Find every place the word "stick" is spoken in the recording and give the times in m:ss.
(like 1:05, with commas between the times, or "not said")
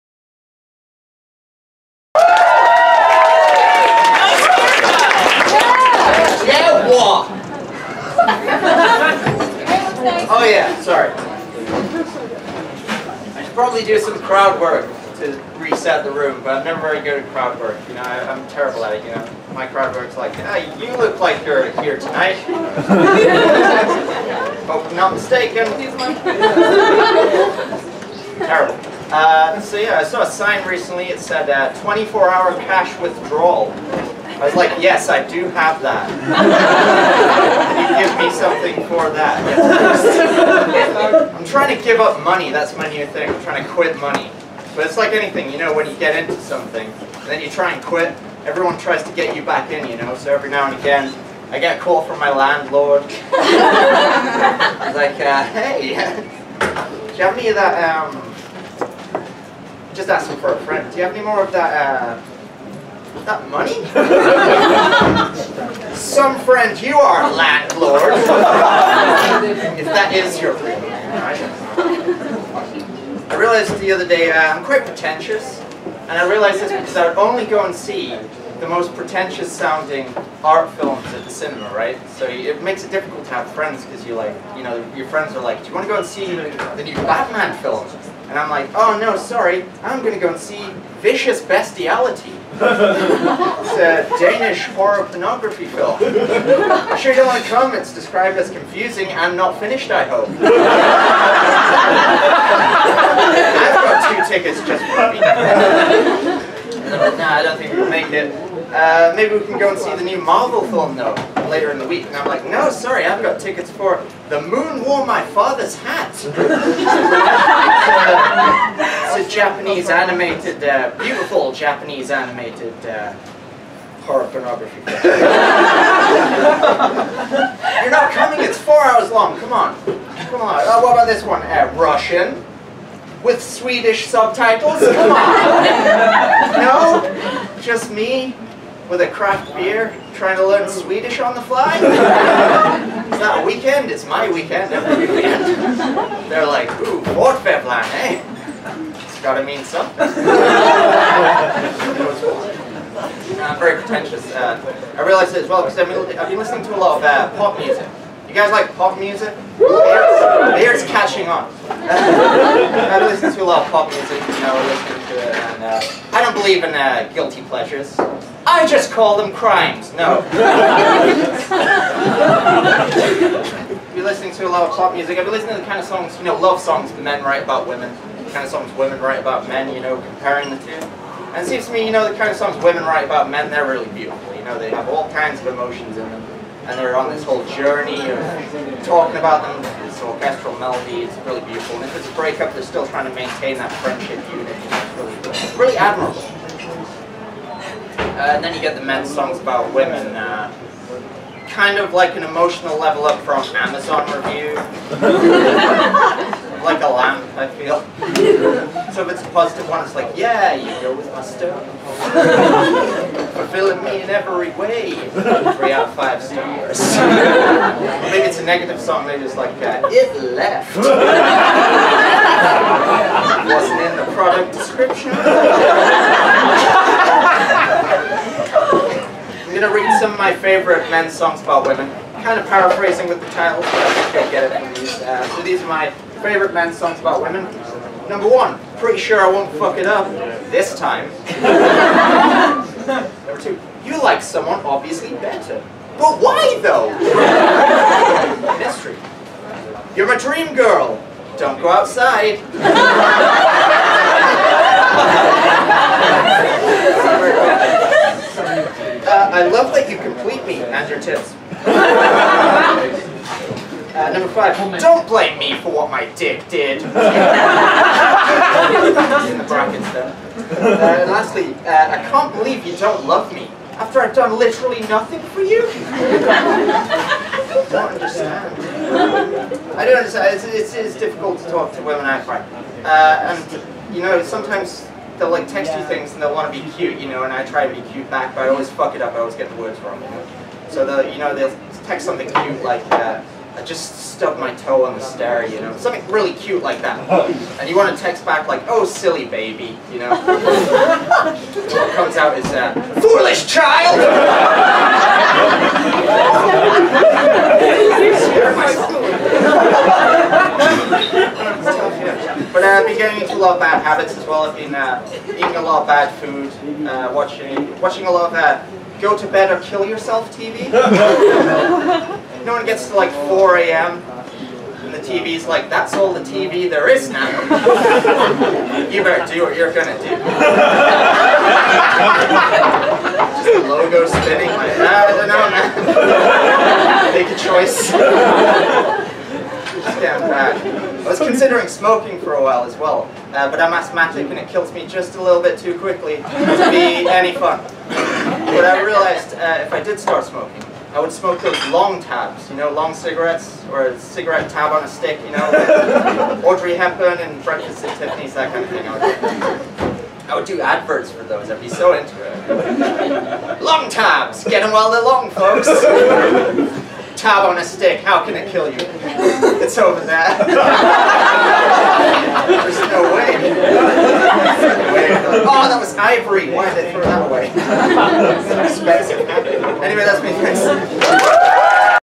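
5:54, 6:07.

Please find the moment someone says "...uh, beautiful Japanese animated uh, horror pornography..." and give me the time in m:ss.
2:00.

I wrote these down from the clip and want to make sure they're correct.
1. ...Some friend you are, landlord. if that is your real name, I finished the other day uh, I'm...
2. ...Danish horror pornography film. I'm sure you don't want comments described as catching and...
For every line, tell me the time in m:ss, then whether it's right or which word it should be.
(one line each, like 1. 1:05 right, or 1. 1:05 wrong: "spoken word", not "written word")
1. 1:05 wrong: "realized", not "finished"
2. 1:34 wrong: "confusing", not "catching".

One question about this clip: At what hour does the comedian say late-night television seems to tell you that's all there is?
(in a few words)
4 a.m.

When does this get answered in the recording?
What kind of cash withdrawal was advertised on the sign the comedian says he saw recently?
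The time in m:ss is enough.
0:31.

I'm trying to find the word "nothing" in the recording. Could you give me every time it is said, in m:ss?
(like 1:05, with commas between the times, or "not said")
4:34.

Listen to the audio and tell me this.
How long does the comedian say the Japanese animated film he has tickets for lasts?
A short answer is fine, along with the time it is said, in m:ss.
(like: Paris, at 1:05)
4 hours, at 2:08.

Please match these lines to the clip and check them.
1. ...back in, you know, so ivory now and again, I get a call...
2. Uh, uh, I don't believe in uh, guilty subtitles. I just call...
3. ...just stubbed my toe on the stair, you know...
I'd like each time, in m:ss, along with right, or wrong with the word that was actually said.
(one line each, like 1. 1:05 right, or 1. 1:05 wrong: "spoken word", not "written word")
1. 0:49 wrong: "every", not "ivory"
2. 2:45 wrong: "pleasures", not "subtitles"
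3. 4:53 right.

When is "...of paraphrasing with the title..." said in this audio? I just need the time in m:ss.
3:52.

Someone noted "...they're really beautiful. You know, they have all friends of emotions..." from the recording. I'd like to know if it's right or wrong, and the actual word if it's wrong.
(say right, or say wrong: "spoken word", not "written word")
wrong: "kinds", not "friends".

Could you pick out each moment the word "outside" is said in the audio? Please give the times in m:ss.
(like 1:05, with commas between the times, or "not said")
4:11.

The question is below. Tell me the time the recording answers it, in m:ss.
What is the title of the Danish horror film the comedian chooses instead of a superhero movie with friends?
1:31.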